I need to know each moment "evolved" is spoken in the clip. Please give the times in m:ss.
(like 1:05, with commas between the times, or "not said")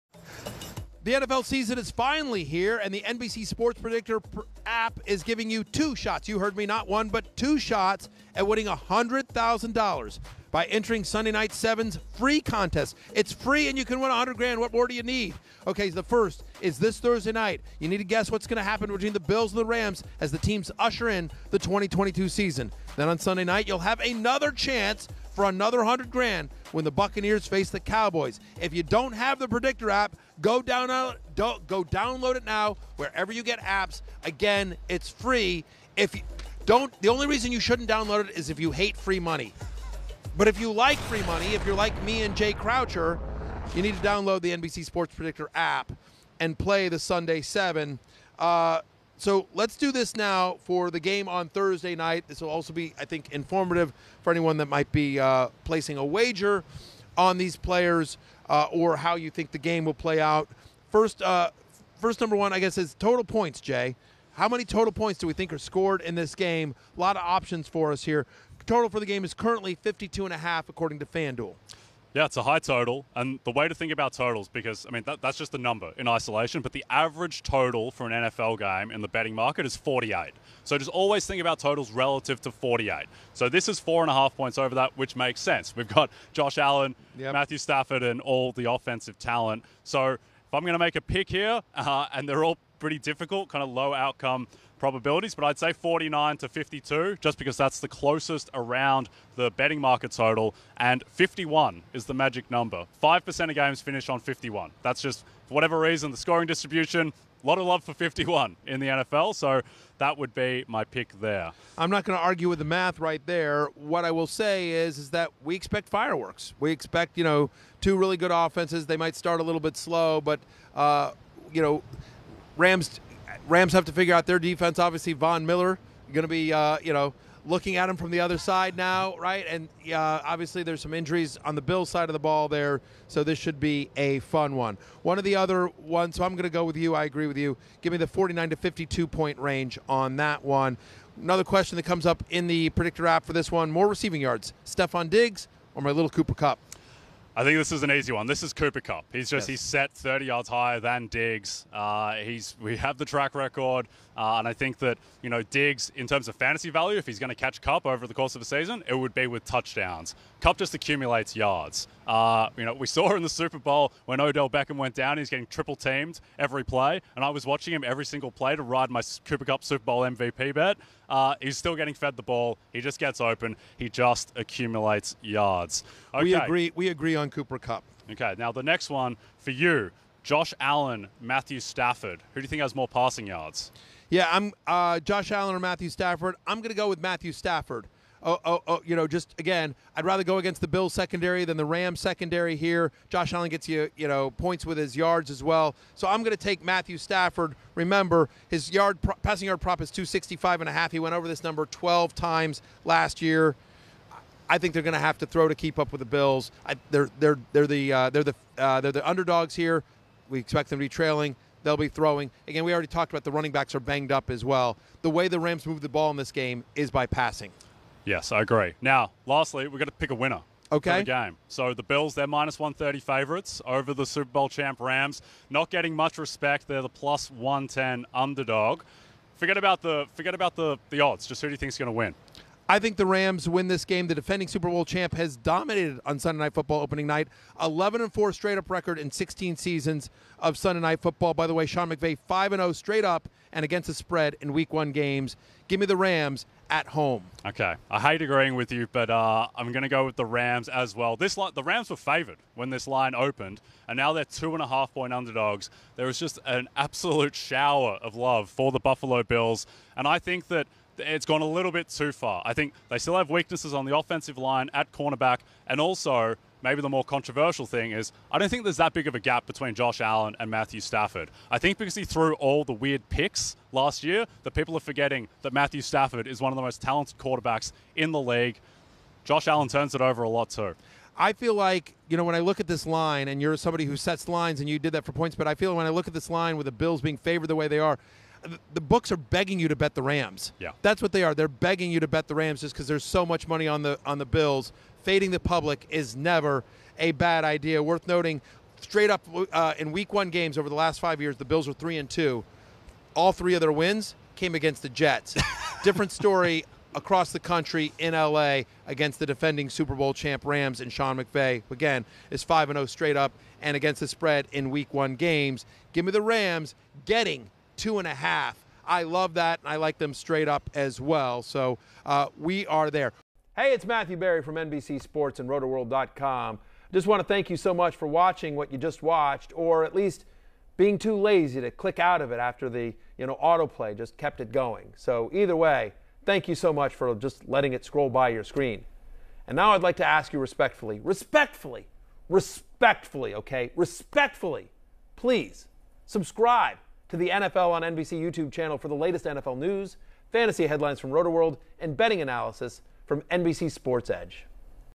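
not said.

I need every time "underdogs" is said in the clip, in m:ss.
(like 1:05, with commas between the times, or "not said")
3:29, 3:48, 4:15.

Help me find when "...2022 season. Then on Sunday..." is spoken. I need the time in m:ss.
0:21.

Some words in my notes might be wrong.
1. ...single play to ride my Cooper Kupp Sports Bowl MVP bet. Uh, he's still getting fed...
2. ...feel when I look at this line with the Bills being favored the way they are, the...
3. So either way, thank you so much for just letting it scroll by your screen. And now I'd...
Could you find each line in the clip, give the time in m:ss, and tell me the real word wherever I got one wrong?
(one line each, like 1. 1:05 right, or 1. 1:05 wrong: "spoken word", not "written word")
1. 2:48 wrong: "Super", not "Sports"
2. 4:45 right
3. 5:34 right.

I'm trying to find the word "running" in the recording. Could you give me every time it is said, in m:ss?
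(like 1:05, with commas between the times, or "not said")
3:33.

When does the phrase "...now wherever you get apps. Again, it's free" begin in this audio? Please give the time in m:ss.
0:32.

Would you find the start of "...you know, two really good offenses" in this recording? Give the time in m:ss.
1:57.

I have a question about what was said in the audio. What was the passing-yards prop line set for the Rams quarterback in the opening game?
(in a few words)
265.5.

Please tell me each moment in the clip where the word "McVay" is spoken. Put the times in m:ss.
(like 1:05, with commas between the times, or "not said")
4:01, 5:11.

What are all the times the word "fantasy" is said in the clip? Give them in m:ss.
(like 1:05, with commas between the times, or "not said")
2:36, 5:50.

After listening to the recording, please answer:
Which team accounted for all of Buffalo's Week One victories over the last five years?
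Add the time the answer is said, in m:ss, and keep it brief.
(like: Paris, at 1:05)
The Jets, at 5:04.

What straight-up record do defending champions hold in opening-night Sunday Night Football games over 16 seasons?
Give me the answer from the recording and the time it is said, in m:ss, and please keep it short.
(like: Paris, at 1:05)
11 and 4, at 3:57.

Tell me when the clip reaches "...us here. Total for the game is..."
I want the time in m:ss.
1:07.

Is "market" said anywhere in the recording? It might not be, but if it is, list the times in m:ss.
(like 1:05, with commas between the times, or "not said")
1:19, 1:39.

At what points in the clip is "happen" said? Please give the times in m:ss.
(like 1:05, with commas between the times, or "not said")
0:18.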